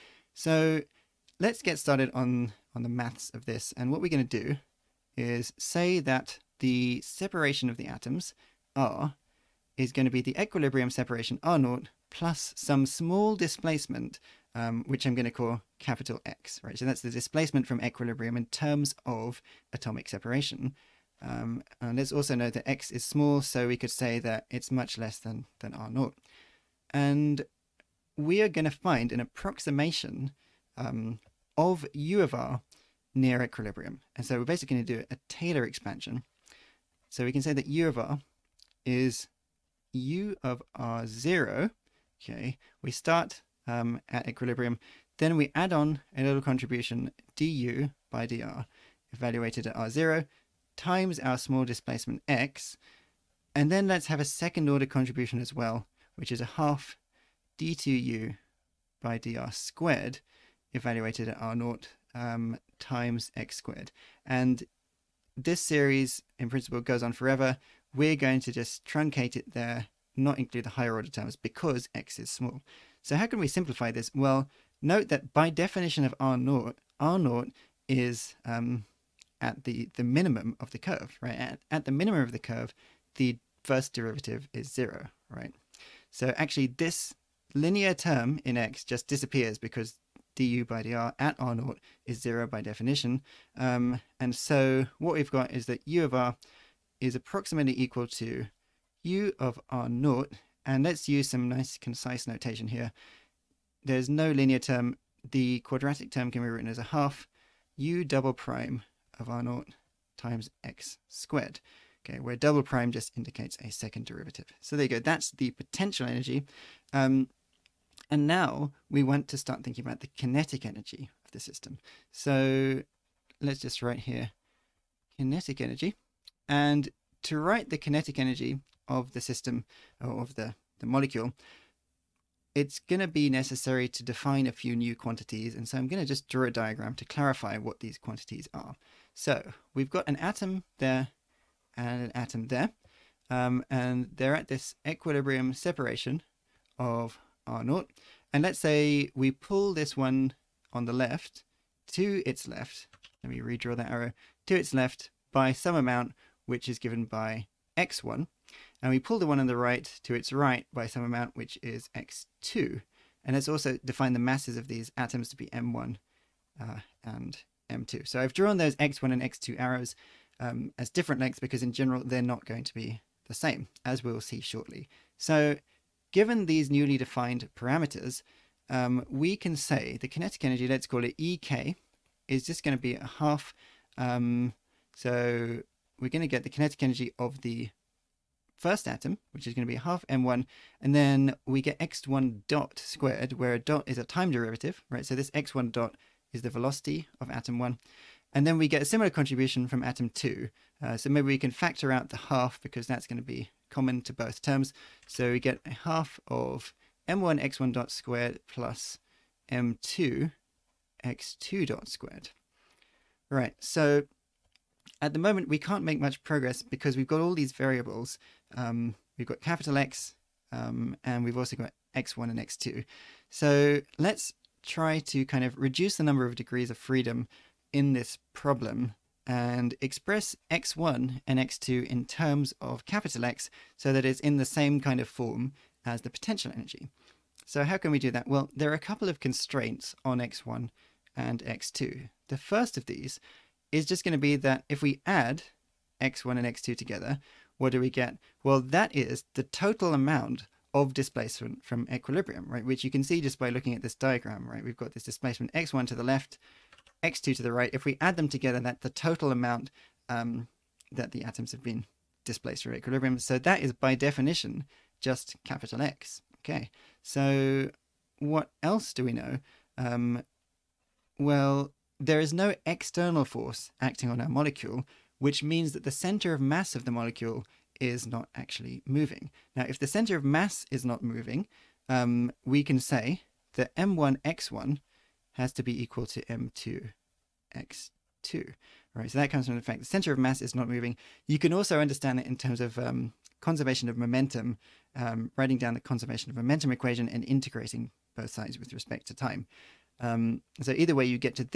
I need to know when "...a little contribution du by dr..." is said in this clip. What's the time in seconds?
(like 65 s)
46 s.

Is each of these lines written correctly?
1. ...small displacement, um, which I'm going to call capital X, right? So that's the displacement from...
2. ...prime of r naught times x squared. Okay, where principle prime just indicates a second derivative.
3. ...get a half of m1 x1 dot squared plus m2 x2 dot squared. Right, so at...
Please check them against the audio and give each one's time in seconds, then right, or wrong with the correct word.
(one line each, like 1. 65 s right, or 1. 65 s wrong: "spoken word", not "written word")
1. 12 s right
2. 108 s wrong: "double", not "principle"
3. 205 s right.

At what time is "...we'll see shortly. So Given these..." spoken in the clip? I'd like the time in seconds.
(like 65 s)
174 s.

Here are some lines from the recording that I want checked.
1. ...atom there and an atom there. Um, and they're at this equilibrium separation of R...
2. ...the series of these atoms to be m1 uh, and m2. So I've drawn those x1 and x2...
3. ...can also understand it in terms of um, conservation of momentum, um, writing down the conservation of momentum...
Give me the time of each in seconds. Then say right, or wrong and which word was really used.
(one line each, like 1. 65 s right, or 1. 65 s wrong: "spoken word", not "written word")
1. 140 s right
2. 164 s wrong: "masses", not "series"
3. 291 s right.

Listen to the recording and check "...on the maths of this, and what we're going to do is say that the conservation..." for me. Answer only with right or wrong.
wrong.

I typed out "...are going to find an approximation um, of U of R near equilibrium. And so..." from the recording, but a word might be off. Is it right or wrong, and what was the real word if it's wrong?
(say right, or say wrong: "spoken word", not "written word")
right.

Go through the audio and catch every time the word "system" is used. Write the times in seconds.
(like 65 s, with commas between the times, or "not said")
121 s, 129 s.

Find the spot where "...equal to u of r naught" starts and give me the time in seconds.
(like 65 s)
97 s.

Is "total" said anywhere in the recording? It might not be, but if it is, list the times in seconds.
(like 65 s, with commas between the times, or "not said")
249 s, 258 s.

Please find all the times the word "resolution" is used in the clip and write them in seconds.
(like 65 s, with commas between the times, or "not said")
not said.